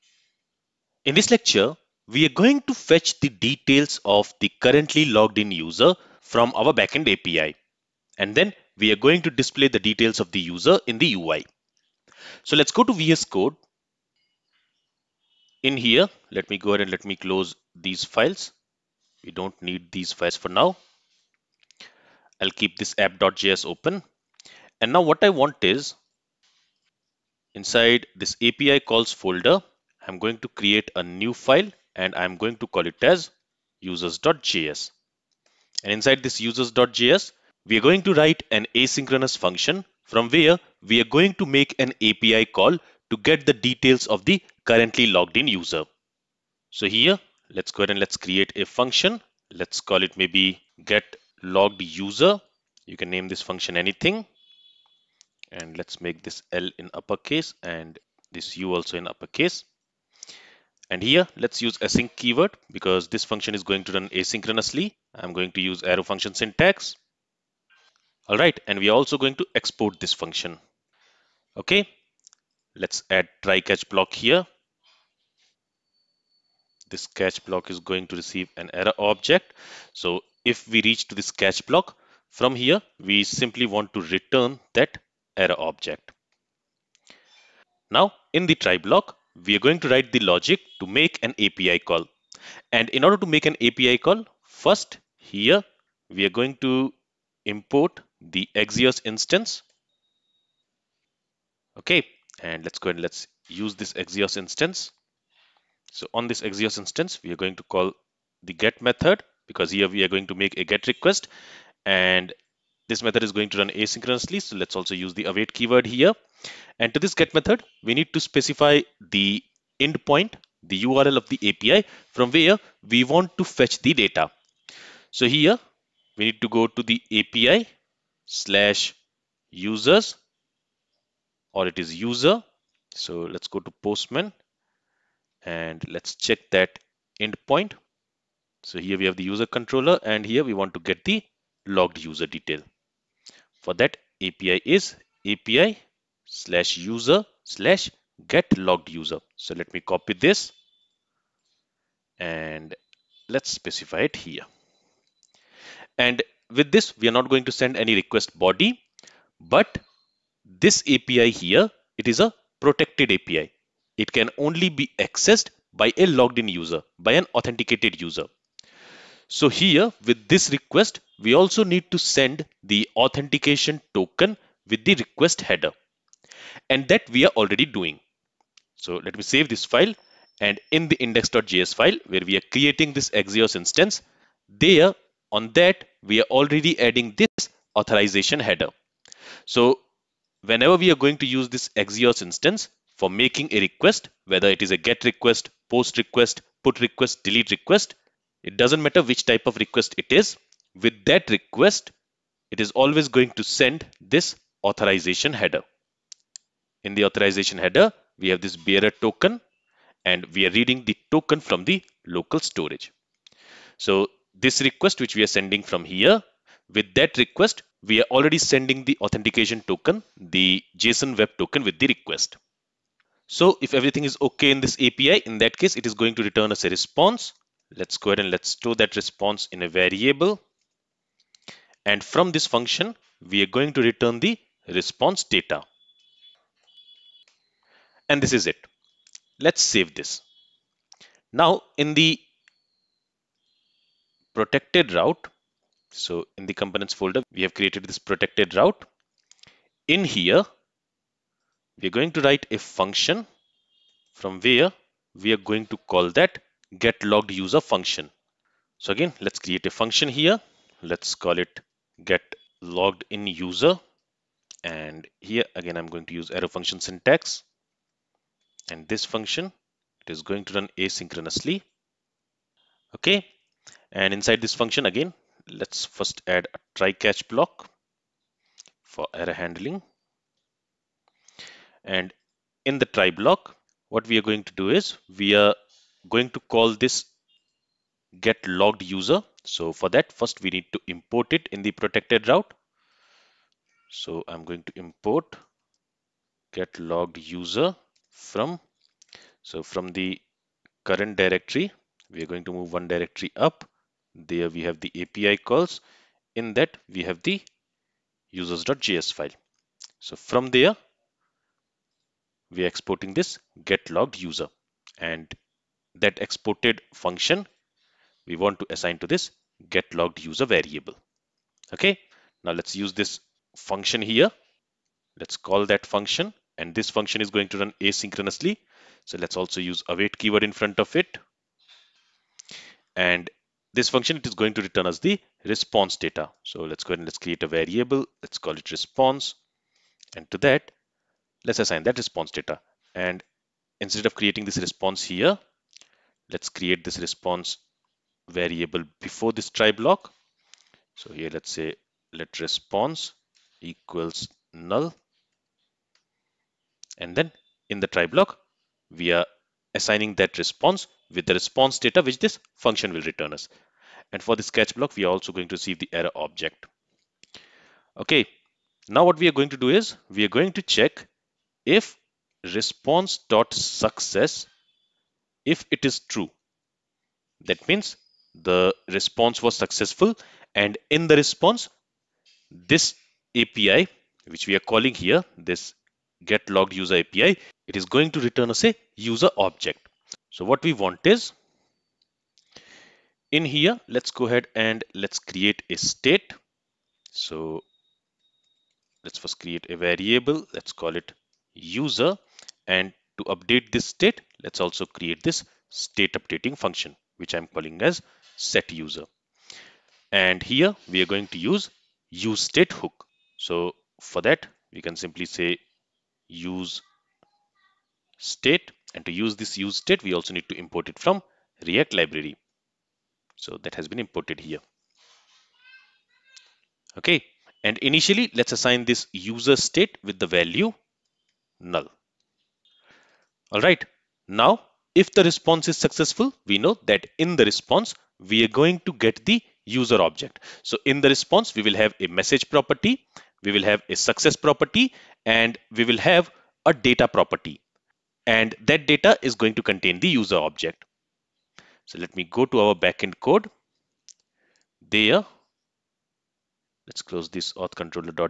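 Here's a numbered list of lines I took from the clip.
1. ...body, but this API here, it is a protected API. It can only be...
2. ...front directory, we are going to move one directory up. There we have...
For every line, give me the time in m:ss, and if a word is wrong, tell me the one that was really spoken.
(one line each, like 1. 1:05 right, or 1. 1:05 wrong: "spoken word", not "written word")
1. 2:38 right
2. 5:00 wrong: "current", not "front".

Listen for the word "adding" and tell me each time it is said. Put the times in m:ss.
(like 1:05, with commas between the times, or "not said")
3:06.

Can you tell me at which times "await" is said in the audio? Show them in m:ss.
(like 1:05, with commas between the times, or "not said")
1:55, 5:29.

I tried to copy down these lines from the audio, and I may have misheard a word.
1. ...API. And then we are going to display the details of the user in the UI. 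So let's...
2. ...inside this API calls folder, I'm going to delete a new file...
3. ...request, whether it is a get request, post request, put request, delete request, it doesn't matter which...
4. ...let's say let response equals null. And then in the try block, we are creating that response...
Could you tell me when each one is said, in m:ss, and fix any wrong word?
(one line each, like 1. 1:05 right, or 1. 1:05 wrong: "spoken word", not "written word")
1. 0:07 right
2. 0:27 wrong: "create", not "delete"
3. 3:13 right
4. 5:51 wrong: "assigning", not "creating".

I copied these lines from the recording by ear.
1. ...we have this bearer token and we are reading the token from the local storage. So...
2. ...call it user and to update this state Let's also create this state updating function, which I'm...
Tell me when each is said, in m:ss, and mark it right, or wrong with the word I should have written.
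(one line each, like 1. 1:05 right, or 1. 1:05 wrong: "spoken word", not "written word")
1. 3:28 right
2. 6:40 right.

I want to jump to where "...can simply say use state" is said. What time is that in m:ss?
6:54.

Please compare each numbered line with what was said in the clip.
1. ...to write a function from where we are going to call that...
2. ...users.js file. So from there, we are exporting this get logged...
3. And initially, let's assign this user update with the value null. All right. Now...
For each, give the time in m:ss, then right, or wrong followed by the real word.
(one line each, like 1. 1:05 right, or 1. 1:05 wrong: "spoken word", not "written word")
1. 4:12 right
2. 5:08 right
3. 7:07 wrong: "state", not "update".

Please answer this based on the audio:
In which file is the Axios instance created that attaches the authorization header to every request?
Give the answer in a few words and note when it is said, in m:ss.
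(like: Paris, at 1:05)
index.js, at 3:00.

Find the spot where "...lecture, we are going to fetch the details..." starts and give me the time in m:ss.
0:01.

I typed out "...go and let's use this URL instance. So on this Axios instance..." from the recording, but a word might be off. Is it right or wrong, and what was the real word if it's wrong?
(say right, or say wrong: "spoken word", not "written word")
wrong: "Axios", not "URL".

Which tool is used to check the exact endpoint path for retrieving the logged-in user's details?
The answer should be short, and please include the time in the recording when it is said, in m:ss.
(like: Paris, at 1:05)
Postman, at 2:13.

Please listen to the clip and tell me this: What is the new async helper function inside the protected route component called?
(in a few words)
get logged in user.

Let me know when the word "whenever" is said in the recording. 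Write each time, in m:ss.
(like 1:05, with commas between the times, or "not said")
3:10.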